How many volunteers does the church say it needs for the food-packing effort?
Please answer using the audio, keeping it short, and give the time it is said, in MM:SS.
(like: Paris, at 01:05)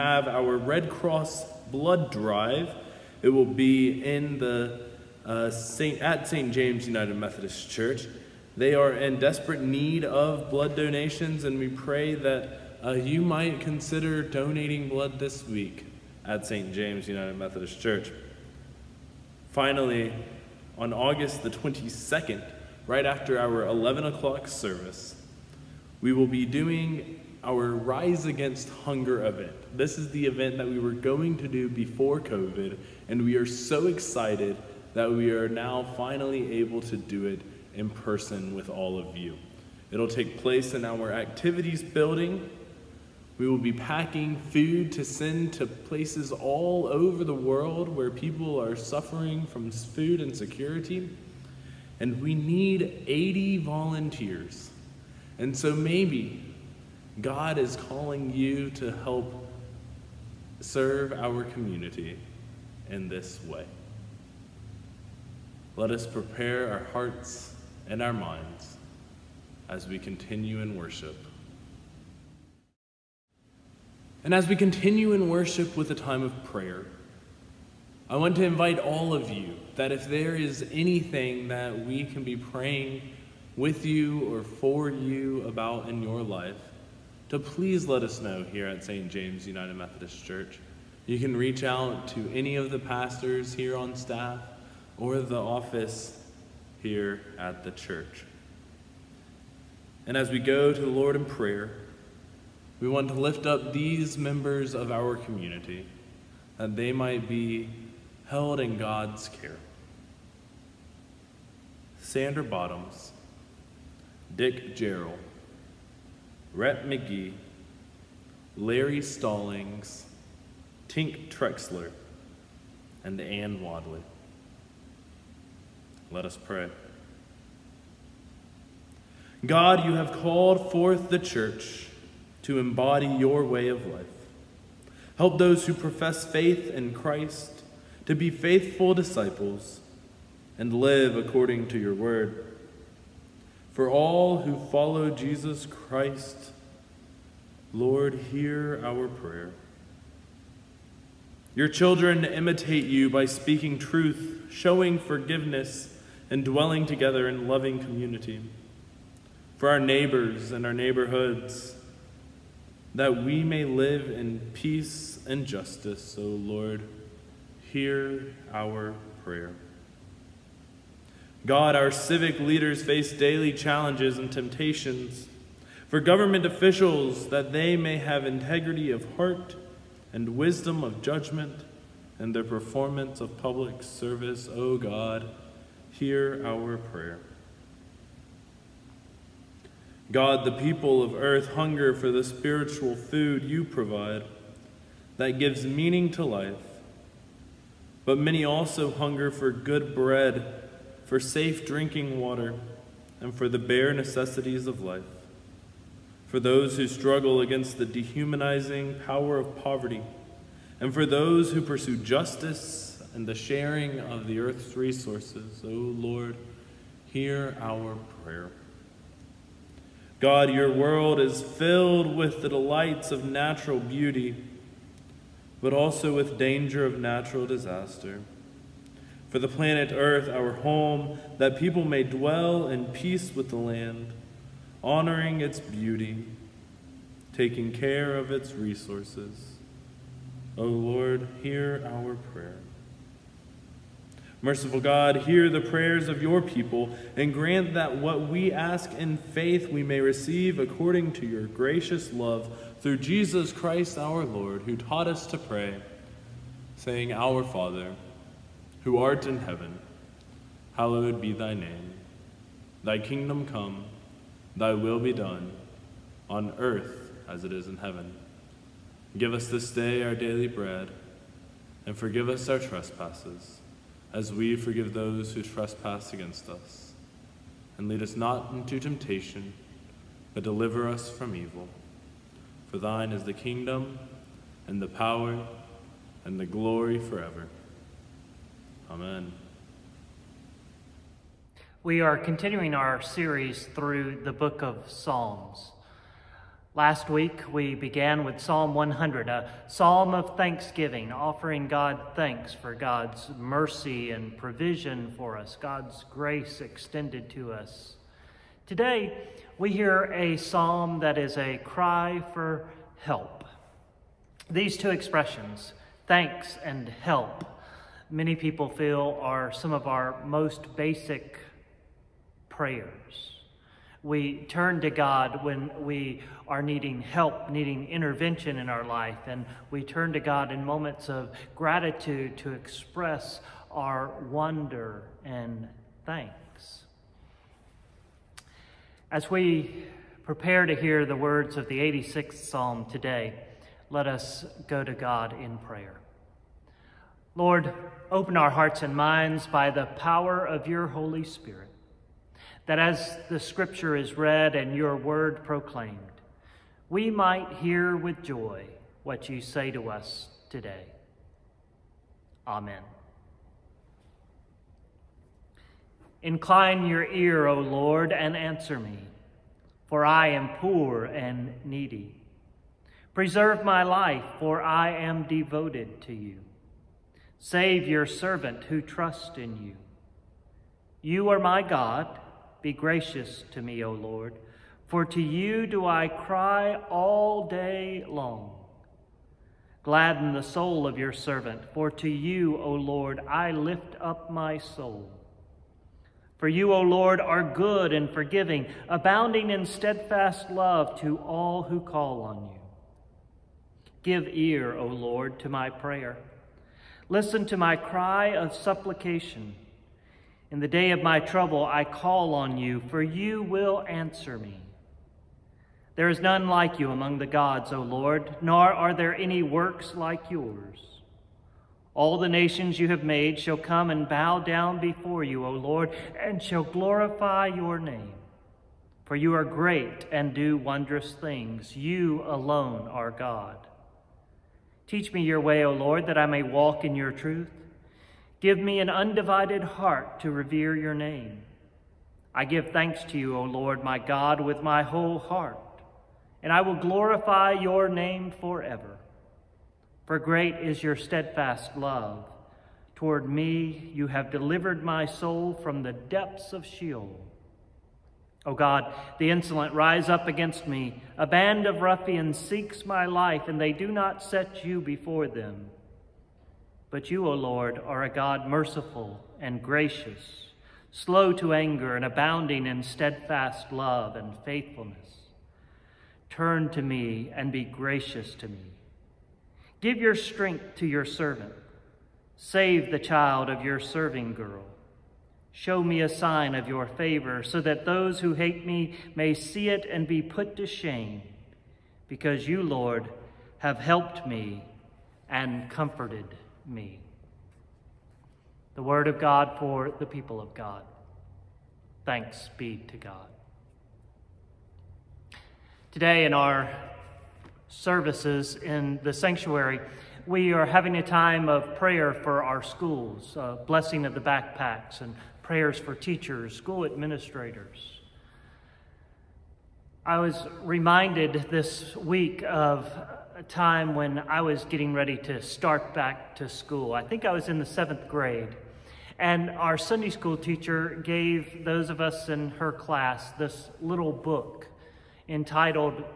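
80, at 00:53.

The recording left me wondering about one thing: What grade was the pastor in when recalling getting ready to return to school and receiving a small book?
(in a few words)
seventh grade.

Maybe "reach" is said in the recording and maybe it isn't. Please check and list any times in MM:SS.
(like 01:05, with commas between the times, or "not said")
01:31.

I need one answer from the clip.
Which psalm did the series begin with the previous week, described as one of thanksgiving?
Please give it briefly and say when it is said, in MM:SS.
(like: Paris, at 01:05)
Psalm 100, at 04:58.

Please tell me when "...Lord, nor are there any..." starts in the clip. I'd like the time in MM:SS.
06:57.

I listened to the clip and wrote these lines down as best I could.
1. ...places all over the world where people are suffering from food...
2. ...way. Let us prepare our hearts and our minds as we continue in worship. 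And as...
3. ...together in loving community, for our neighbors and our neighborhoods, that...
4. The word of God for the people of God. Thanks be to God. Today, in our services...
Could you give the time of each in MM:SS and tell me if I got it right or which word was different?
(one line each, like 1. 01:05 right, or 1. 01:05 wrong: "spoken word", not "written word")
1. 00:45 right
2. 01:03 right
3. 02:36 right
4. 08:18 right.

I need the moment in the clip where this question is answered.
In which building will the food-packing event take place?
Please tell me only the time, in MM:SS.
00:41.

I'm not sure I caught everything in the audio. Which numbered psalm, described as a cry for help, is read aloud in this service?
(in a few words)
86th Psalm.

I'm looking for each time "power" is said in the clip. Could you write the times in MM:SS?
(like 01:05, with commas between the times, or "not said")
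03:29, 04:44, 05:49.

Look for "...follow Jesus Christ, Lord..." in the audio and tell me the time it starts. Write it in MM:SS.
02:24.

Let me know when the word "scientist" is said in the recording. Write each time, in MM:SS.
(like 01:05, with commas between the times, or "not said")
not said.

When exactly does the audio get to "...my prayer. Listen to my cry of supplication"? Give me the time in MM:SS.
06:45.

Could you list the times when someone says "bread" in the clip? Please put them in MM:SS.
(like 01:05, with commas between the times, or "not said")
03:19, 04:30.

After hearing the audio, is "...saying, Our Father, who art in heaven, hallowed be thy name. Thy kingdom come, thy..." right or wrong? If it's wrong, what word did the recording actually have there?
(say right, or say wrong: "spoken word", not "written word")
right.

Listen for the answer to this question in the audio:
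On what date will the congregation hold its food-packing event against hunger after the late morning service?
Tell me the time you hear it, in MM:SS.
00:20.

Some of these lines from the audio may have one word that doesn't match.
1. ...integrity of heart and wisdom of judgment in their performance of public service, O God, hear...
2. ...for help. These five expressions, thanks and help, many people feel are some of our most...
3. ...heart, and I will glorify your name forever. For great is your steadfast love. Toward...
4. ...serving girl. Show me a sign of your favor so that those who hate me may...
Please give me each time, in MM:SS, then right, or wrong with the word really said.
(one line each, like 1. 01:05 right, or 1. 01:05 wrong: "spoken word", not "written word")
1. 02:58 right
2. 05:12 wrong: "two", not "five"
3. 07:25 right
4. 08:03 right.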